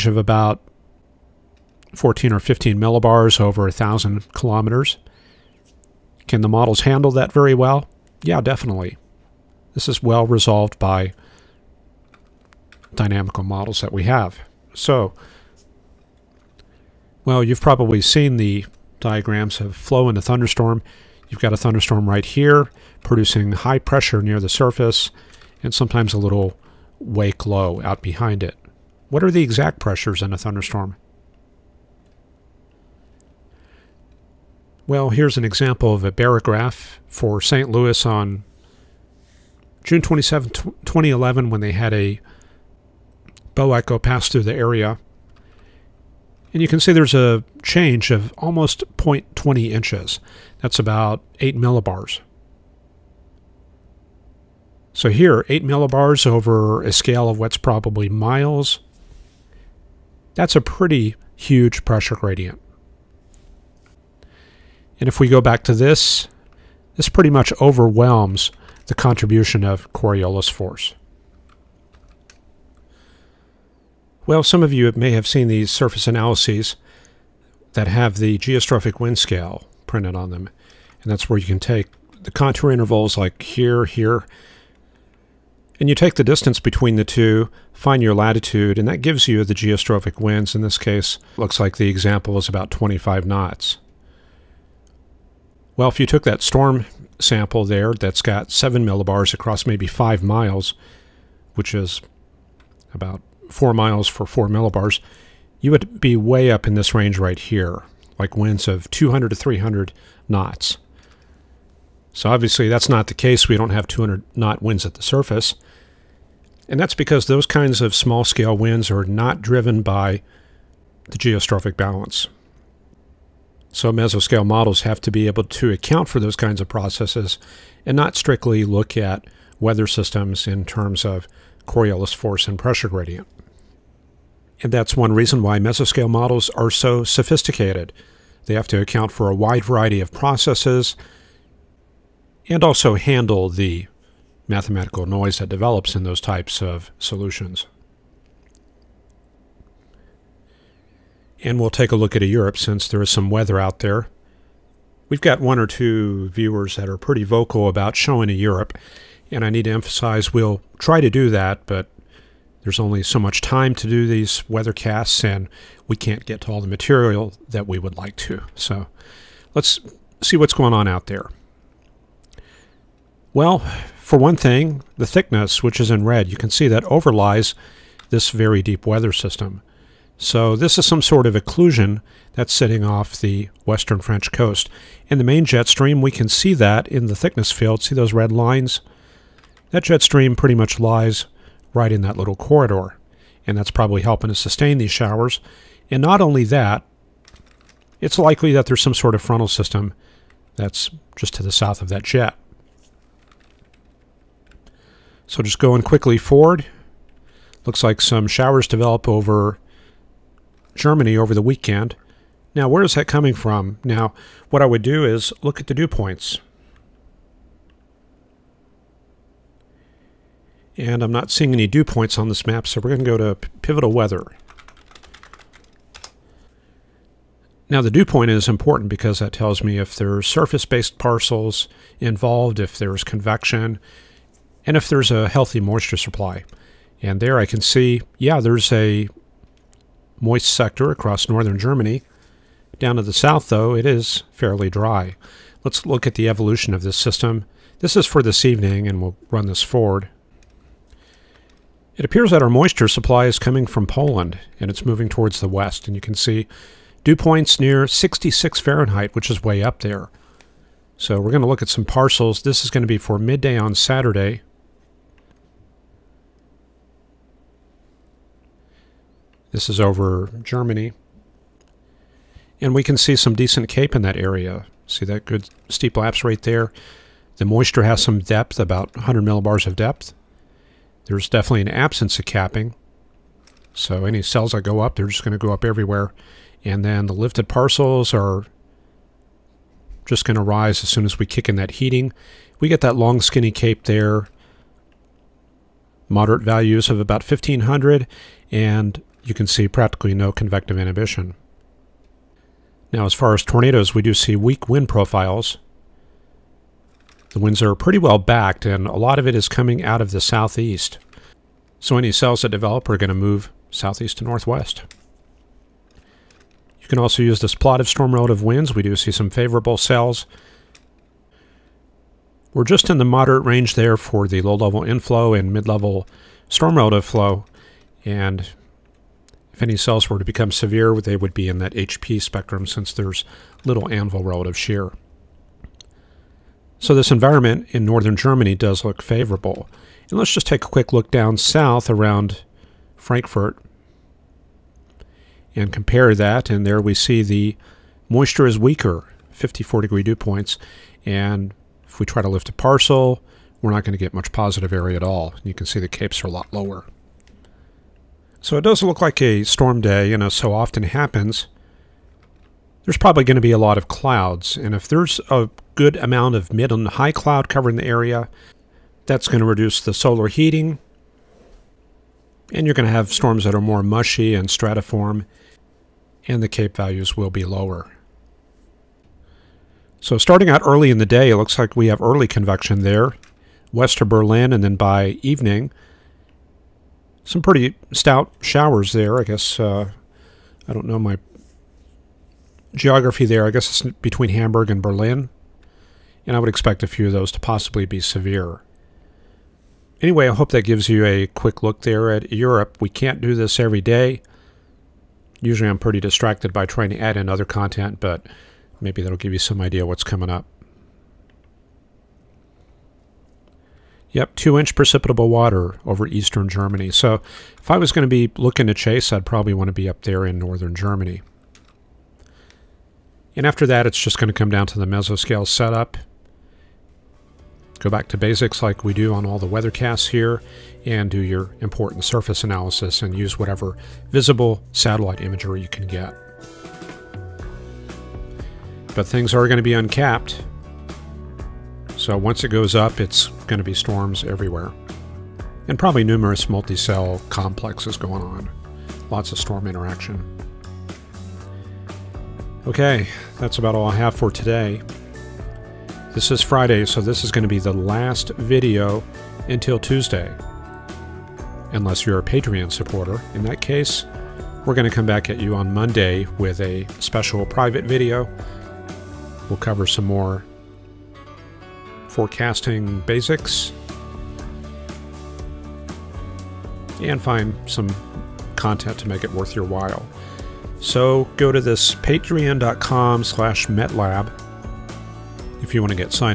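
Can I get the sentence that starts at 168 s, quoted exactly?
So let's see what's going on out there.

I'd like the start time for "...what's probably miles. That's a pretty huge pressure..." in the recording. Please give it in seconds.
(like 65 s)
57 s.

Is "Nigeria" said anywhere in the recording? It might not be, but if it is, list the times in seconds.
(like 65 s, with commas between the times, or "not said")
not said.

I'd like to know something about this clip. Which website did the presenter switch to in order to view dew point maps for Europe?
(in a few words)
Pivotal Weather.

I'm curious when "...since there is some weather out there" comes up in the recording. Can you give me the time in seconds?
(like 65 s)
152 s.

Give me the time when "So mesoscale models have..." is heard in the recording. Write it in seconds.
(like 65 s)
123 s.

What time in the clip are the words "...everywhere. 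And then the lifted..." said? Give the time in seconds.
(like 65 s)
285 s.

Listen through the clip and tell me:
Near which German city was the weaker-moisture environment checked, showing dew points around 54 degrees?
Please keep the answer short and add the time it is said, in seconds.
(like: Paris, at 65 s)
Frankfurt, at 342 s.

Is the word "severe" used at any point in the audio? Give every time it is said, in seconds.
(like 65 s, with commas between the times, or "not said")
330 s, 398 s.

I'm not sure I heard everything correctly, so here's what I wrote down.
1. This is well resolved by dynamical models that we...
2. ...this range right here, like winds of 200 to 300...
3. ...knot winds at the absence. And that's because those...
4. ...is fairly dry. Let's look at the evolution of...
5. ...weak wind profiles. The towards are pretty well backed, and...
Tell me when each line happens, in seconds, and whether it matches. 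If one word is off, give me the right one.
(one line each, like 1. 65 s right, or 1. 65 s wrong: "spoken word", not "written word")
1. 9 s right
2. 106 s right
3. 114 s wrong: "surface", not "absence"
4. 243 s right
5. 304 s wrong: "winds", not "towards".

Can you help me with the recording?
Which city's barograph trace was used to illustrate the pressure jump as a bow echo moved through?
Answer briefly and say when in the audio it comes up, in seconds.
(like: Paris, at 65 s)
St. Louis, at 37 s.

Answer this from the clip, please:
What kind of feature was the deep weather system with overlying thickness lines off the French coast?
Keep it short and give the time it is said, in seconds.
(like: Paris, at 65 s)
occlusion, at 181 s.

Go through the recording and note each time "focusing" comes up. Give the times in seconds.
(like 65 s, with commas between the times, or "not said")
not said.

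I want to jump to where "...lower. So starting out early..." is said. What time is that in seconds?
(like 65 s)
377 s.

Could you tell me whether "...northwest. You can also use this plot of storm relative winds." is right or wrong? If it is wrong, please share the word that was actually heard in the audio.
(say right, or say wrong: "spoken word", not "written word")
right.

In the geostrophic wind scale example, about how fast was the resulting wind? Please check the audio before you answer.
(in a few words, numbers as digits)
25 knots.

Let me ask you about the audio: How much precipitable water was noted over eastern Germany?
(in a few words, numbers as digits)
2 inches.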